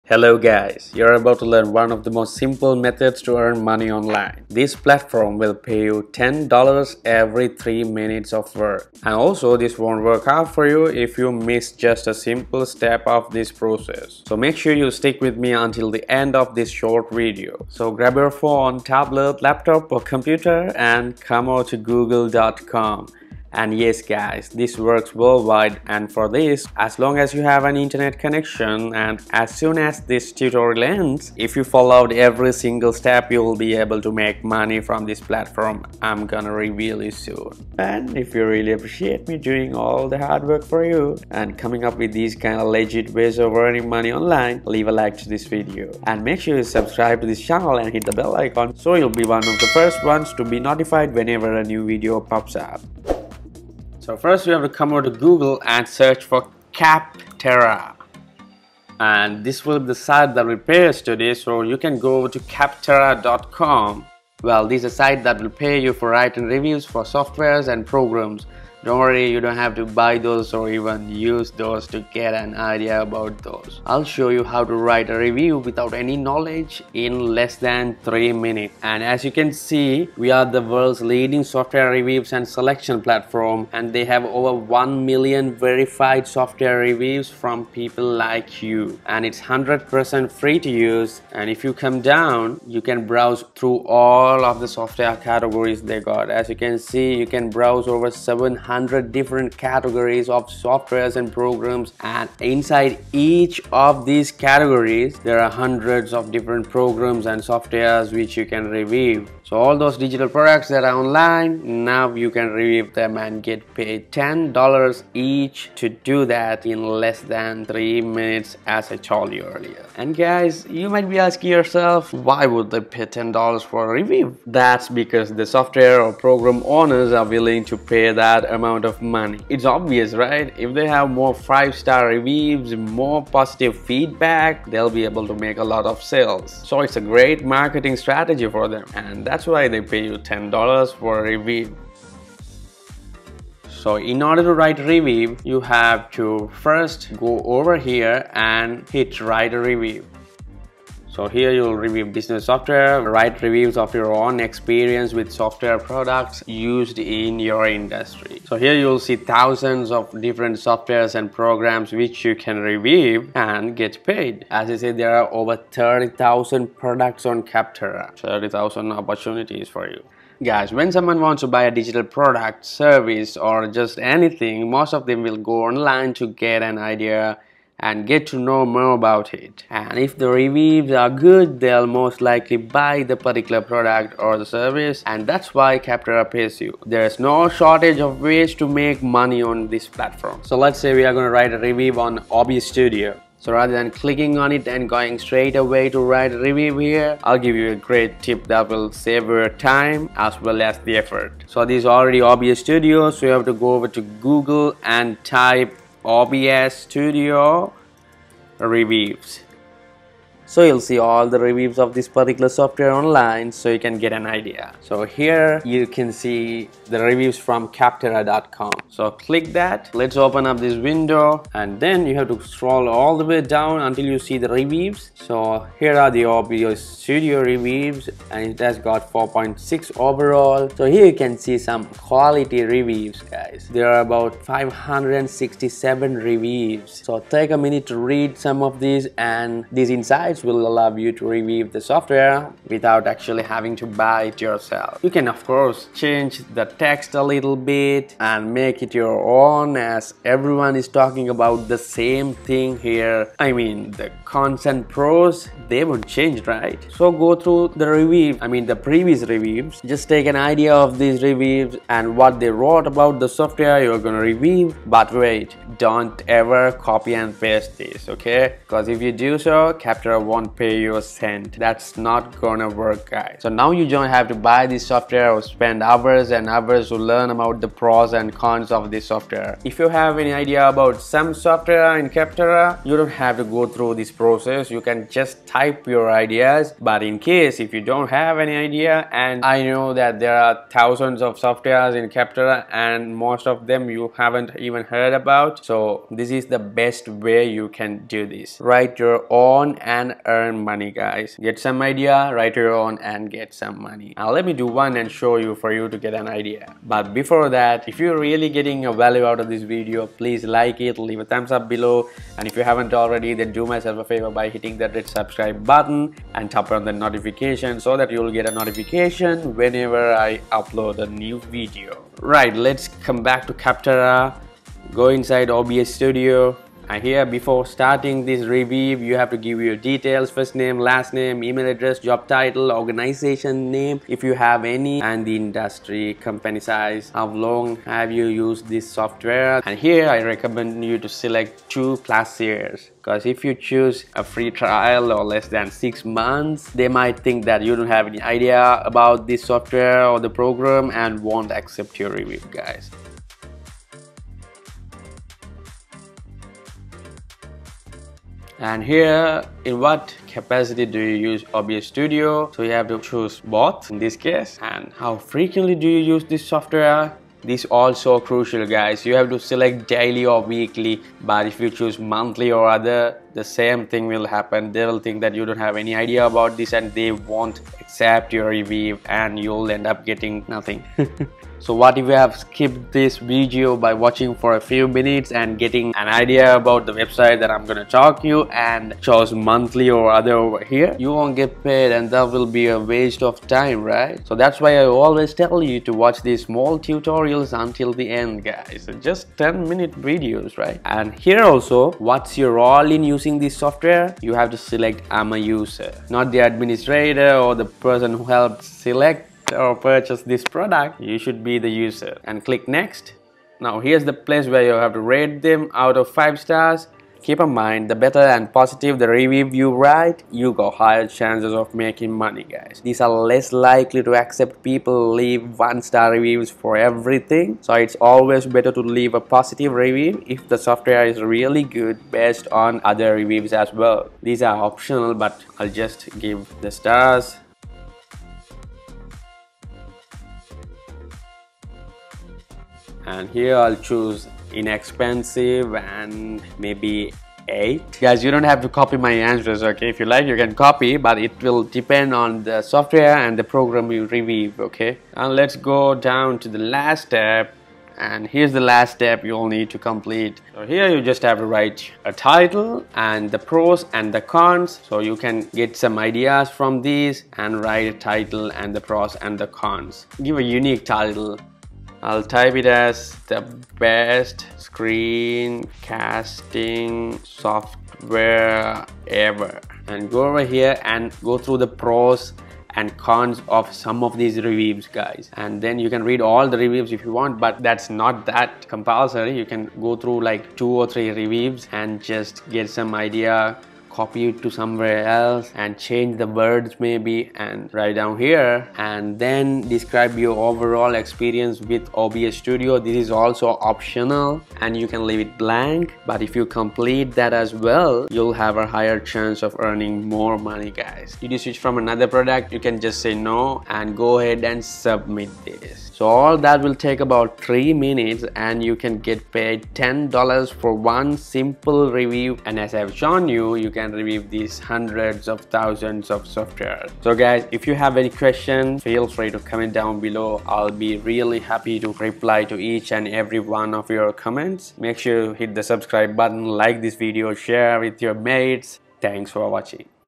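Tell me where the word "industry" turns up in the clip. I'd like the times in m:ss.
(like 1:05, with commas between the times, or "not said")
2:37, 5:35.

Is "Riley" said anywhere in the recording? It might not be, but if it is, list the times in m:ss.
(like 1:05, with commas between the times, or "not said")
not said.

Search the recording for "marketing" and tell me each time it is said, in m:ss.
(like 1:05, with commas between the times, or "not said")
2:17.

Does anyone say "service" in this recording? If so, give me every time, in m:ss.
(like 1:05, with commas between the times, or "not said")
2:52, 3:04.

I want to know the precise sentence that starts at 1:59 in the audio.
And guys, you might be asking yourself, why would they pay $10 for a review?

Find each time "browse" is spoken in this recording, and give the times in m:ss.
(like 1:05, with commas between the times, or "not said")
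1:33, 1:37.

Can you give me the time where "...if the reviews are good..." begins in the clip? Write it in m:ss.
2:59.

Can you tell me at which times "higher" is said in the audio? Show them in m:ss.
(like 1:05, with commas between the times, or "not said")
7:00, 8:28.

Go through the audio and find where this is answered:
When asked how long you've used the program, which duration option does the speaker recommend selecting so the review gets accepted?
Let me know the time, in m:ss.
5:41.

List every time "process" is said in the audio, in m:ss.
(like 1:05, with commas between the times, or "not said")
0:13, 4:44.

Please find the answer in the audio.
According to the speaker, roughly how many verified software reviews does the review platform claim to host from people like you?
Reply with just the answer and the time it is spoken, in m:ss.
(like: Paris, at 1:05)
over 1 million, at 1:24.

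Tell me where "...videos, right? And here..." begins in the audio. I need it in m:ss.
6:40.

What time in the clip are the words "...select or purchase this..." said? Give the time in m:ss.
6:48.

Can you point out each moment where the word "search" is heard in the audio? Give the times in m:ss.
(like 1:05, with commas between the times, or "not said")
0:55.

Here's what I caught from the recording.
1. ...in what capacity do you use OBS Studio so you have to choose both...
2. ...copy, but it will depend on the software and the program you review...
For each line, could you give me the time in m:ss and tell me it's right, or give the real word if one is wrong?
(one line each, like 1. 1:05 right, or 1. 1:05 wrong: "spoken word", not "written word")
1. 5:59 right
2. 7:30 right.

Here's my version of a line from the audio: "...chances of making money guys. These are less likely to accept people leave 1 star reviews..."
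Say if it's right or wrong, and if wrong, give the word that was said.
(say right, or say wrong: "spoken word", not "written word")
right.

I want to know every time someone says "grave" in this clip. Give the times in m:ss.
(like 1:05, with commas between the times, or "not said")
not said.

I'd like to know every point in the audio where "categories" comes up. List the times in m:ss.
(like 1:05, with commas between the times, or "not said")
1:35, 1:39, 1:44.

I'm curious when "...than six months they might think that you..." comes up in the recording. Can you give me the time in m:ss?
5:45.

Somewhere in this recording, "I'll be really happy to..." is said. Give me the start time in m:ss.
8:50.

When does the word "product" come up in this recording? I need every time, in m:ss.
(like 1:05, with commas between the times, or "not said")
1:50, 2:35, 2:46, 2:52, 3:03, 6:50, 8:32.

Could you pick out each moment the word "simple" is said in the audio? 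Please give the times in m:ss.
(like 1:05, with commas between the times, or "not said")
0:02, 0:12, 8:41.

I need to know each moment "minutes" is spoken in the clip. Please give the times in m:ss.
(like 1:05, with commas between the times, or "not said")
0:07, 1:18, 1:57, 3:57, 6:24, 6:39, 8:37.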